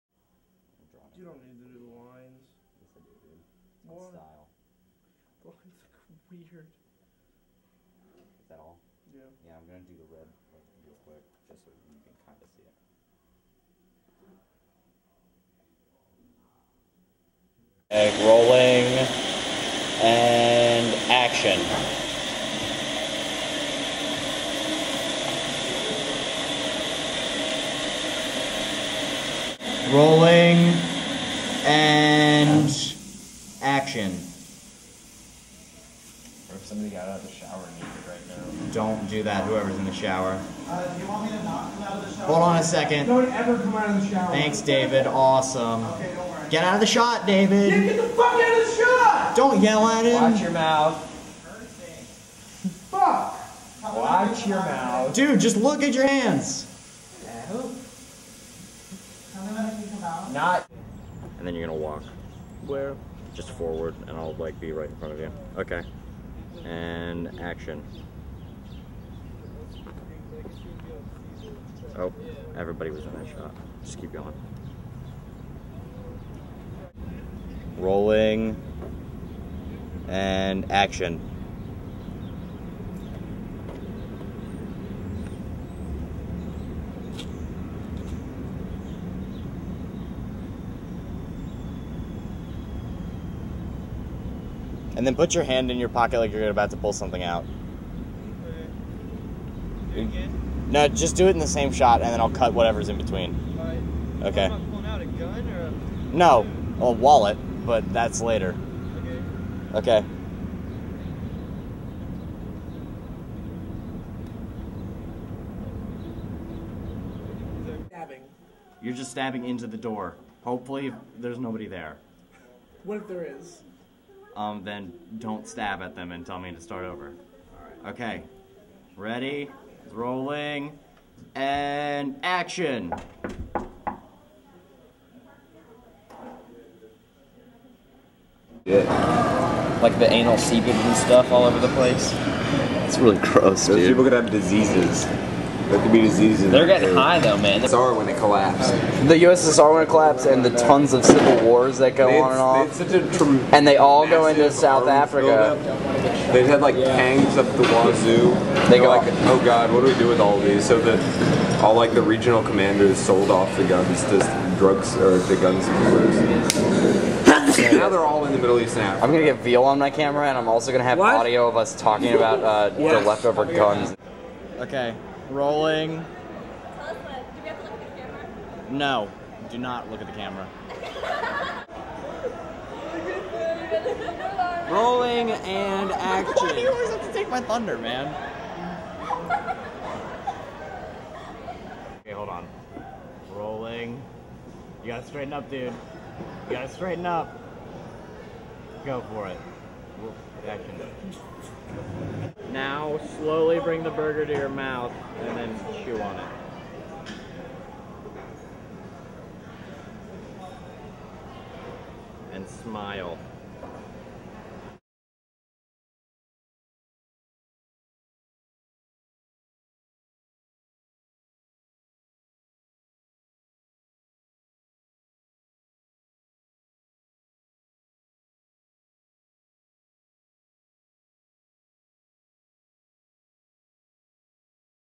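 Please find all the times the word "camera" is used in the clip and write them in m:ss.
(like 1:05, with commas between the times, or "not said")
2:49, 3:00.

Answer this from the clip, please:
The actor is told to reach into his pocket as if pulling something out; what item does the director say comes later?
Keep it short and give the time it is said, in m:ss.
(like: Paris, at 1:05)
a wallet, at 1:46.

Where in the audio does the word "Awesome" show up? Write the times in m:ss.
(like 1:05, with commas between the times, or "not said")
0:45.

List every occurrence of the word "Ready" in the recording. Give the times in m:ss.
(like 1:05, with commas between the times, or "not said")
2:08.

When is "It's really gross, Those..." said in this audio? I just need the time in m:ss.
2:22.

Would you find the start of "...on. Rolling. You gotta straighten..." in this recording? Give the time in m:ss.
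3:12.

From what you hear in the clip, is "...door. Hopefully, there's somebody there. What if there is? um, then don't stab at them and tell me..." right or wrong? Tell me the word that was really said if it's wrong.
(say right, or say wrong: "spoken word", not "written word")
wrong: "nobody", not "somebody".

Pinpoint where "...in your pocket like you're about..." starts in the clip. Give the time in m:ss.
1:35.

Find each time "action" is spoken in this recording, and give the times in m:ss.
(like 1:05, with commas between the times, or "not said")
0:21, 0:33, 1:07, 1:20, 2:12, 3:05, 3:20.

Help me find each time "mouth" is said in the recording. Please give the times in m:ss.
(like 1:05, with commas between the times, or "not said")
0:50, 0:54, 3:24.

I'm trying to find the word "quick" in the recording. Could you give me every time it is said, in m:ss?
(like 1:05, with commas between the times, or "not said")
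0:11.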